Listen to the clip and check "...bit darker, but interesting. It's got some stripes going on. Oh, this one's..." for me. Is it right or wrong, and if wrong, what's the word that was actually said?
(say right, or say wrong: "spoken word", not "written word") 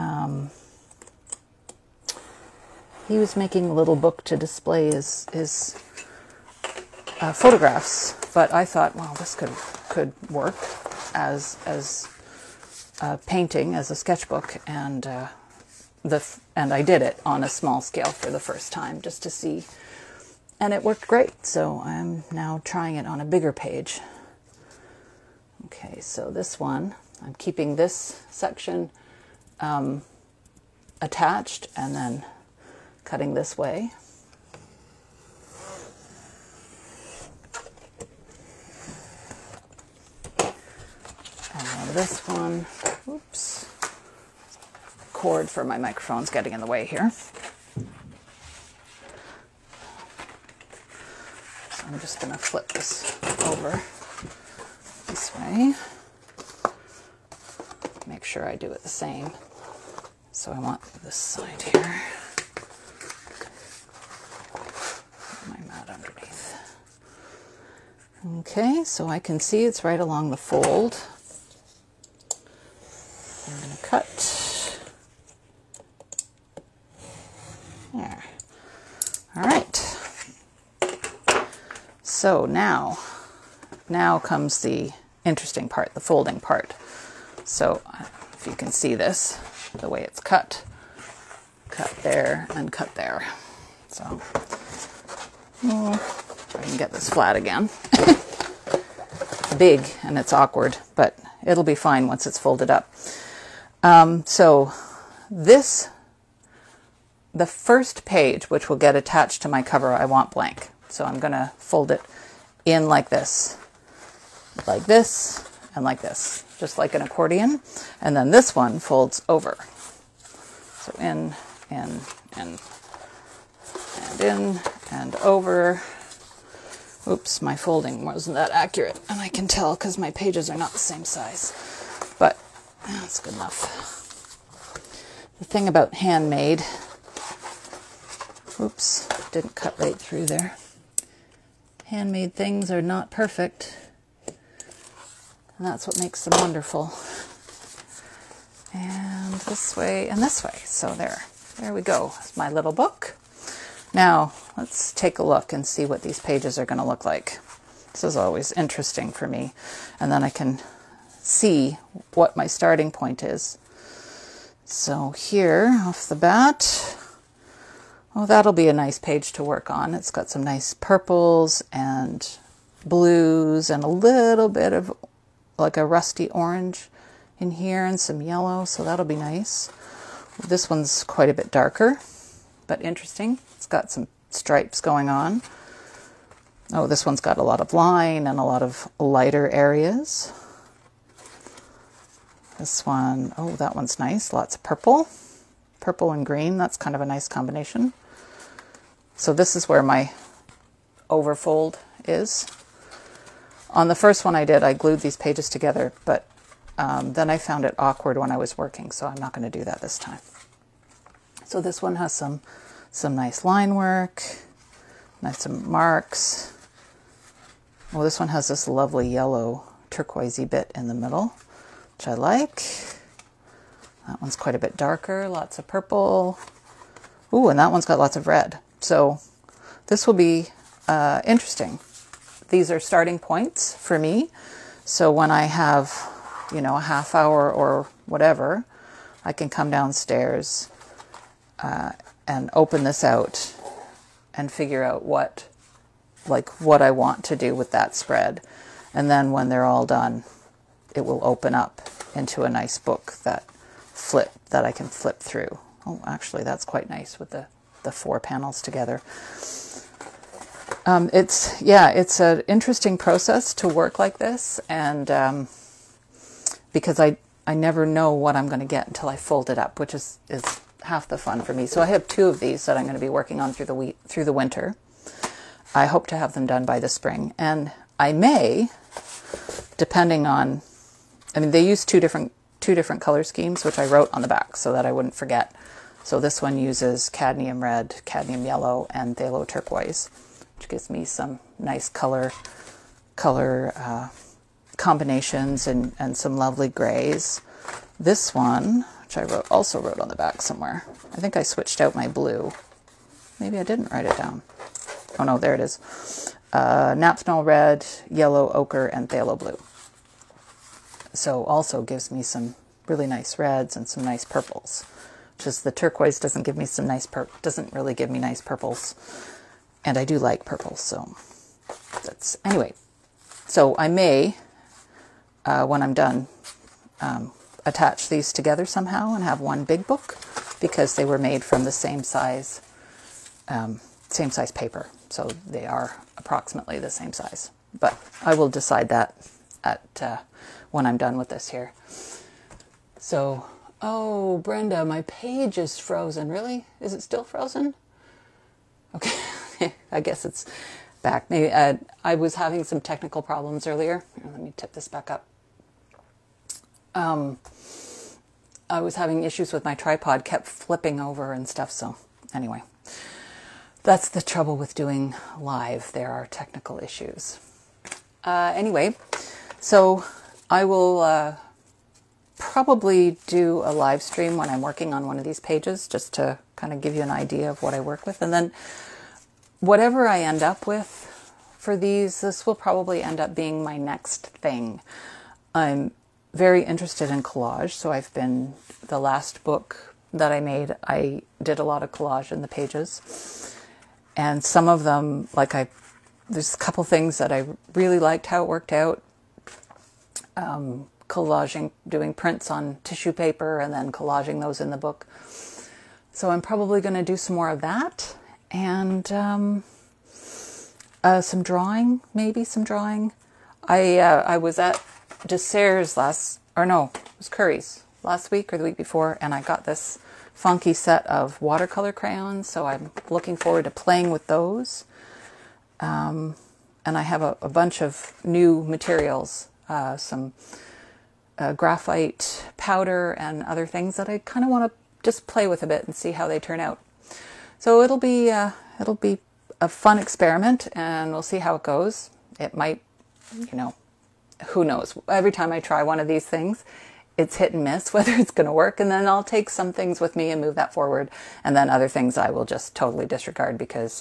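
right.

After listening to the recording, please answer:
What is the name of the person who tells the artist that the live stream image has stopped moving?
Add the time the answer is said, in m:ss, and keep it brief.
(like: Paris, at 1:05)
Brenda, at 5:44.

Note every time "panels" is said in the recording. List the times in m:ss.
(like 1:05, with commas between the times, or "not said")
4:18.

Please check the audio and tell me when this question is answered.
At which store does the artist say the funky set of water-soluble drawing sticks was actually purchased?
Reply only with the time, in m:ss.
6:57.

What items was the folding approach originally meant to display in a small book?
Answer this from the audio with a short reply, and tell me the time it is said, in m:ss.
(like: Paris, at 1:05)
photographs, at 0:07.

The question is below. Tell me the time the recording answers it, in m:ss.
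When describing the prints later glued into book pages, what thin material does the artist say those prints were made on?
6:42.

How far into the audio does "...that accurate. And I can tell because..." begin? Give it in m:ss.
2:08.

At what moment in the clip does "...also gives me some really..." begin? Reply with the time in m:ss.
5:11.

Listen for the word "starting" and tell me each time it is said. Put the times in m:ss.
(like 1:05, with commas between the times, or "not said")
2:42, 3:52.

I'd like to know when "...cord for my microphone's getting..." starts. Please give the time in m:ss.
0:45.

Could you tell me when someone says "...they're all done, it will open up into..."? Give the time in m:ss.
4:09.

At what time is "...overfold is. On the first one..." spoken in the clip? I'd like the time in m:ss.
3:21.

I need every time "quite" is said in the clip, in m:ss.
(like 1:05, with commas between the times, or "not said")
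3:01, 3:44, 4:16.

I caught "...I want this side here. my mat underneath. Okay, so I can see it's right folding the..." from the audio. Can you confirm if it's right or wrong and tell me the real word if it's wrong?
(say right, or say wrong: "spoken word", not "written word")
wrong: "along", not "folding".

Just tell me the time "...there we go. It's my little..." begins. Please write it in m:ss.
2:31.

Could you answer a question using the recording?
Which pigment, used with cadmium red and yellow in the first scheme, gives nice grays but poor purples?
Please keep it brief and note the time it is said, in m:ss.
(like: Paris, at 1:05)
phthalo turquoise, at 4:49.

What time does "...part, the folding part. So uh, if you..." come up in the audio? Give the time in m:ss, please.
1:25.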